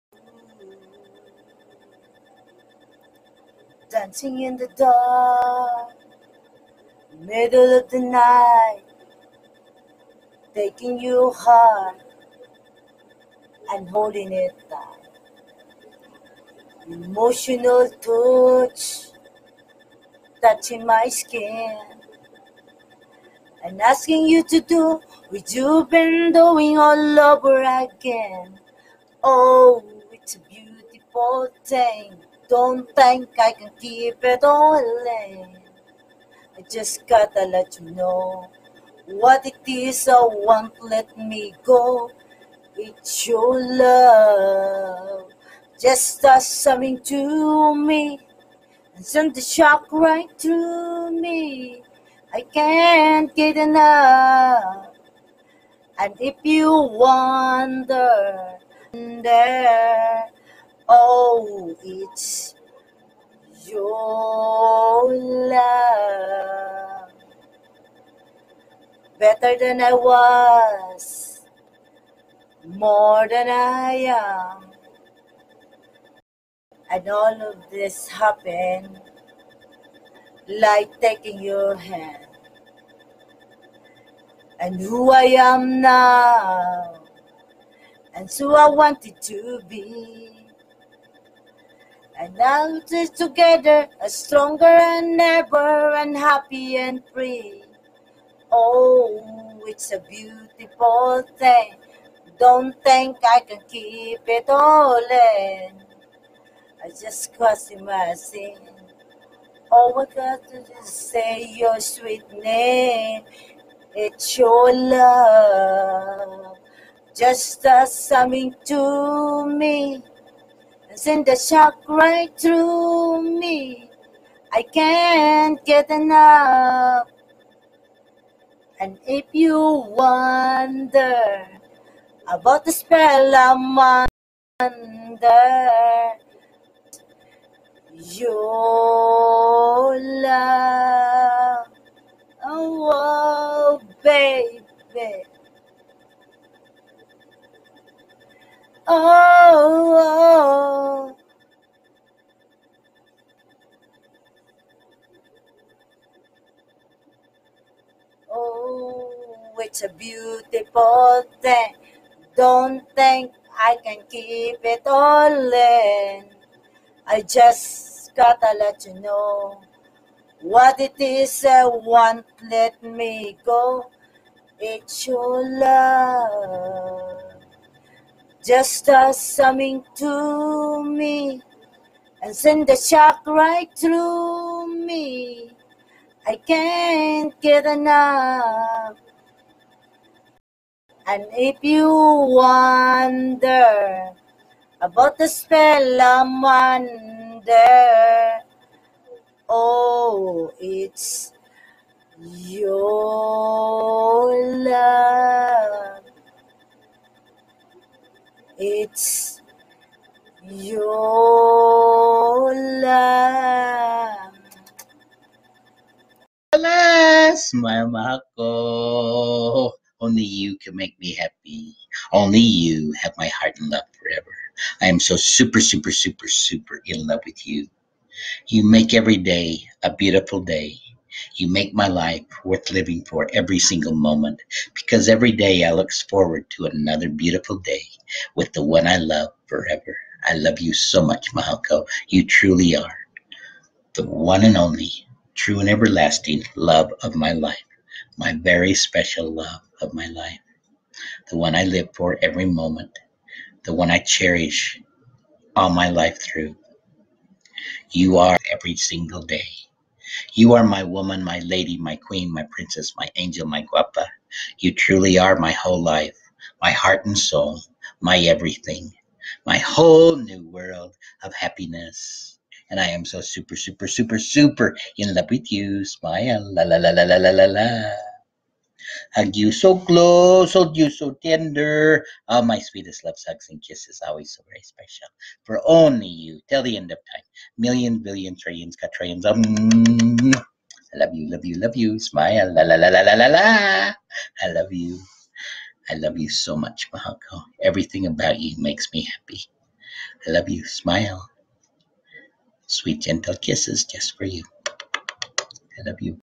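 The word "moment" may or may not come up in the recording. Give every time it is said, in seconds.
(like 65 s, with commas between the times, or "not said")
233 s, 252 s.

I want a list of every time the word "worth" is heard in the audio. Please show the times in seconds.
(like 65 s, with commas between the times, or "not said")
232 s.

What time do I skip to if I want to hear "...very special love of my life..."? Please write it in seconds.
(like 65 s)
248 s.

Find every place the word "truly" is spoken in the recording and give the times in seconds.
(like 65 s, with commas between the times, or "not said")
242 s, 264 s.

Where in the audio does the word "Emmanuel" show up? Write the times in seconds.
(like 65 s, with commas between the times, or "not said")
not said.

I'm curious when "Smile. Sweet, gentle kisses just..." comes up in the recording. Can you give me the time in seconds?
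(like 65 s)
300 s.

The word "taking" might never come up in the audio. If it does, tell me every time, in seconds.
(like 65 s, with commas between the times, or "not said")
10 s, 80 s.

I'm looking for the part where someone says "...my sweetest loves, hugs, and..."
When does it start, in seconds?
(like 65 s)
282 s.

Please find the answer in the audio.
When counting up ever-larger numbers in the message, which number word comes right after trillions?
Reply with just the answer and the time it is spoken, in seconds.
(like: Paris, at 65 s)
quadrillions, at 288 s.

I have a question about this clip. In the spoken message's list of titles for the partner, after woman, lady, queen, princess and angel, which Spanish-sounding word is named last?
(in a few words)
guapa.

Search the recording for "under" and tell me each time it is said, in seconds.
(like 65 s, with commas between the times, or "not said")
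134 s, 196 s.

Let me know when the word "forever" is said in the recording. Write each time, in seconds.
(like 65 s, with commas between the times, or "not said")
223 s, 239 s.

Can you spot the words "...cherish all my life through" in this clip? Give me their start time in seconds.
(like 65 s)
253 s.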